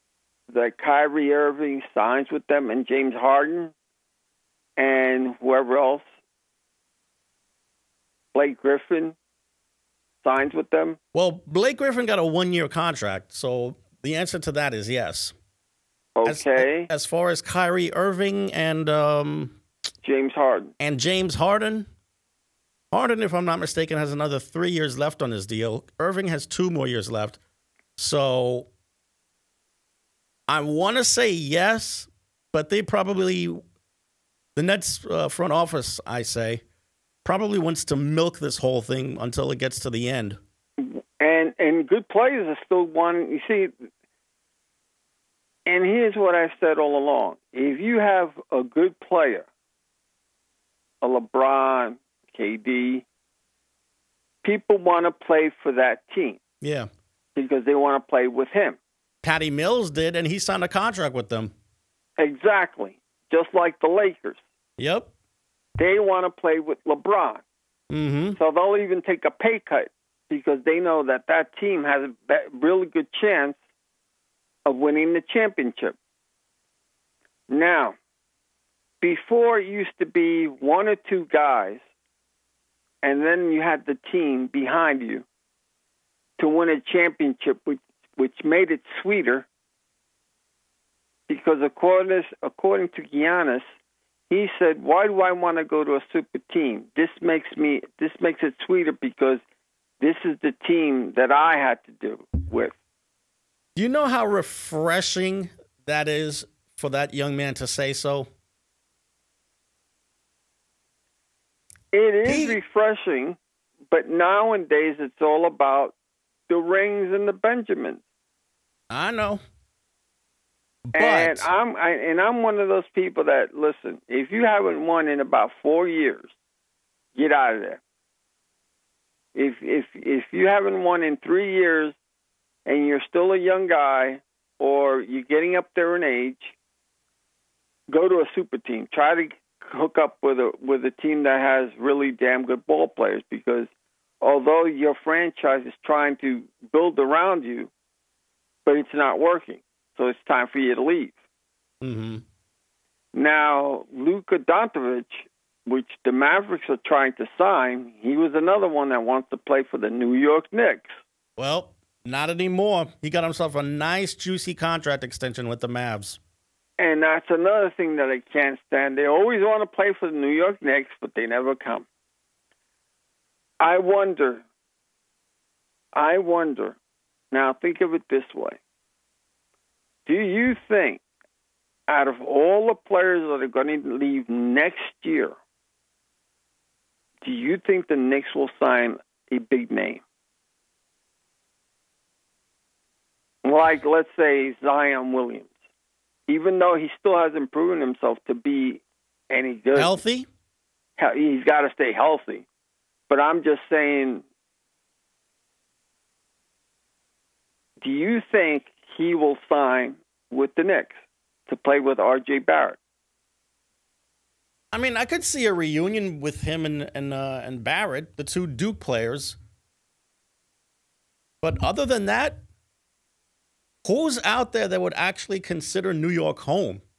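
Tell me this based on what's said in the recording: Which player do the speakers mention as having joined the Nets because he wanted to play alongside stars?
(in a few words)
Patty Mills.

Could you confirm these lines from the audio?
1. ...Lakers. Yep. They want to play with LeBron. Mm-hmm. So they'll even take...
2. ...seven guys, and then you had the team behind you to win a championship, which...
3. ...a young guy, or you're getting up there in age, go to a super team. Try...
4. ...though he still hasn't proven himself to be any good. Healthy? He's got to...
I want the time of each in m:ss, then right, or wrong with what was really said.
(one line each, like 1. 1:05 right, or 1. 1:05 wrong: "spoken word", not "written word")
1. 1:03 right
2. 1:20 wrong: "two", not "seven"
3. 2:13 right
4. 3:16 right.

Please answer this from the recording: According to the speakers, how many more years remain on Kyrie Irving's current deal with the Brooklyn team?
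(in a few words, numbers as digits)
2.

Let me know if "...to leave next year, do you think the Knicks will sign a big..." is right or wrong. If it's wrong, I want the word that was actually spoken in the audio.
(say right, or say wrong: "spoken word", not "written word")
right.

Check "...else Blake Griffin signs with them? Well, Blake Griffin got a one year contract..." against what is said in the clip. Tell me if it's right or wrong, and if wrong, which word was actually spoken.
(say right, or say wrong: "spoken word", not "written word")
right.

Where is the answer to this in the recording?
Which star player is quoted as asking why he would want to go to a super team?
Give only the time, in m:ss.
1:33.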